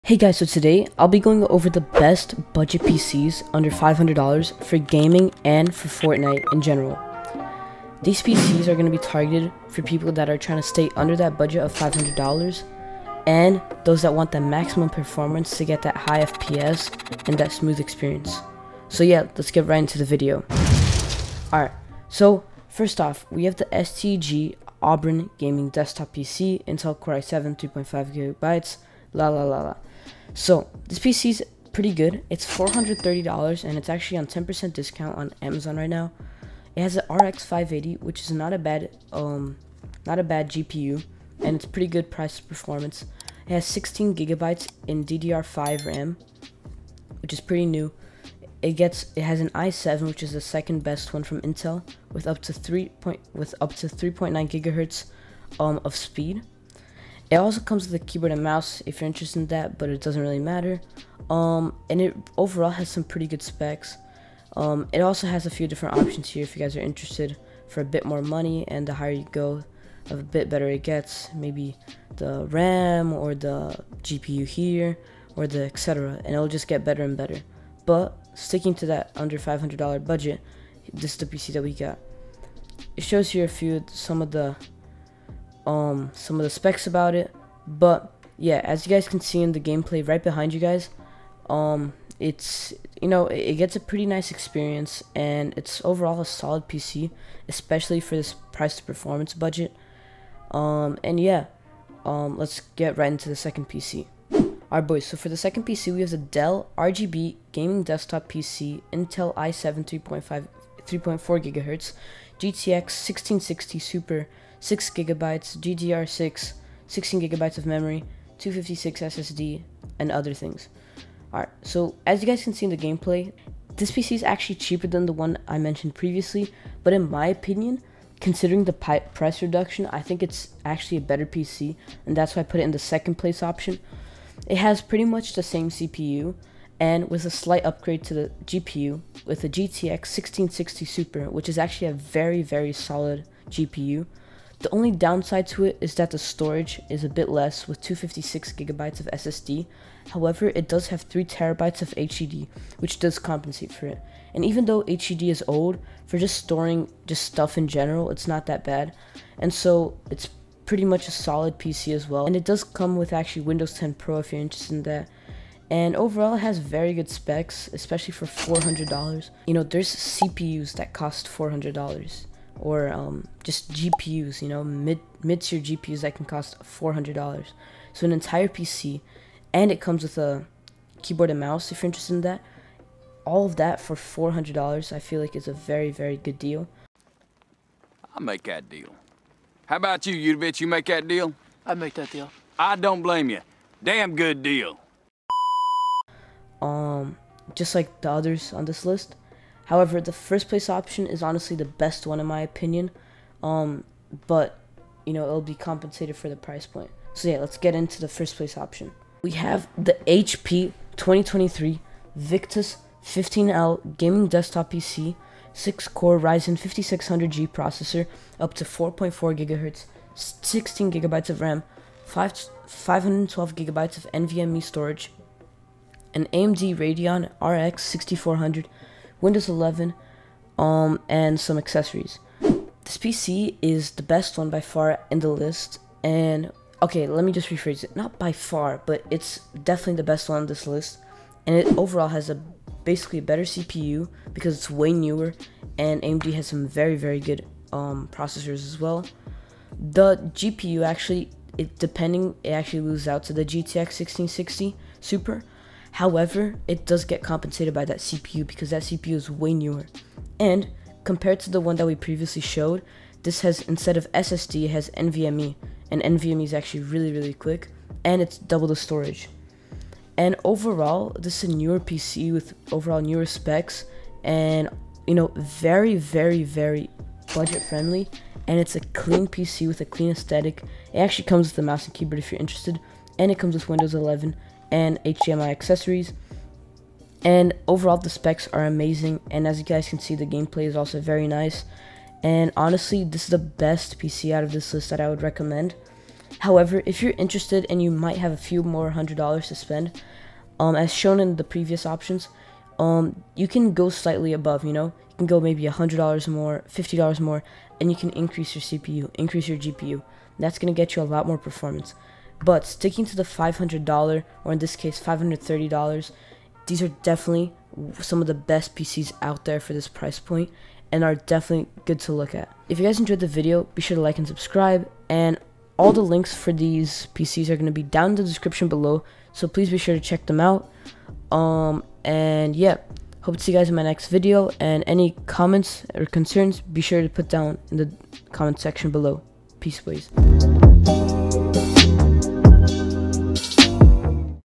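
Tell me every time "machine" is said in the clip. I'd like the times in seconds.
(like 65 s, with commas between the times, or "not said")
not said.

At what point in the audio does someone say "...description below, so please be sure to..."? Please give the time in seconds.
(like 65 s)
328 s.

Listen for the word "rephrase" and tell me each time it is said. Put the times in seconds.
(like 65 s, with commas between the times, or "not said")
237 s.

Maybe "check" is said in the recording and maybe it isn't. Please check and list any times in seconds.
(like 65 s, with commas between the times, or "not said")
330 s.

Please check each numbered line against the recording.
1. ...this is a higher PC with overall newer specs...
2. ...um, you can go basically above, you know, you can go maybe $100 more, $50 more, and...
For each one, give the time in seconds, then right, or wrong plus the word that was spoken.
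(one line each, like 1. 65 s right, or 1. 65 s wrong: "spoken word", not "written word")
1. 271 s wrong: "newer", not "higher"
2. 302 s wrong: "slightly", not "basically".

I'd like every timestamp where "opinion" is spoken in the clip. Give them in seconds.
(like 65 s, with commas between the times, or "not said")
127 s, 202 s.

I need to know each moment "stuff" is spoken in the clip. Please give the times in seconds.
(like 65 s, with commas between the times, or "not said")
157 s.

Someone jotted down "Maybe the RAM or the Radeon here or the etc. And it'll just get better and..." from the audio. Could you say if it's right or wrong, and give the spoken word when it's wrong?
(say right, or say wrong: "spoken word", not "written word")
wrong: "GPU", not "Radeon".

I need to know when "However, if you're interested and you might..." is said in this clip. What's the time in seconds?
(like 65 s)
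296 s.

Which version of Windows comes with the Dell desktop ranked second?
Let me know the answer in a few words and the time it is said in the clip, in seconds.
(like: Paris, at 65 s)
Windows 10 Pro, at 163 s.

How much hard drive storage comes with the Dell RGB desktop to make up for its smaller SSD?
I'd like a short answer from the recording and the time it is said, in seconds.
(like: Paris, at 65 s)
3TB, at 151 s.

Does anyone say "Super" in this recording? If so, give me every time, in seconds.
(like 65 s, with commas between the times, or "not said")
113 s, 140 s, 254 s.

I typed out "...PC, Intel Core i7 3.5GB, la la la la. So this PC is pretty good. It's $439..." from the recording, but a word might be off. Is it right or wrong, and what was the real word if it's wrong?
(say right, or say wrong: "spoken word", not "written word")
wrong: "430", not "439".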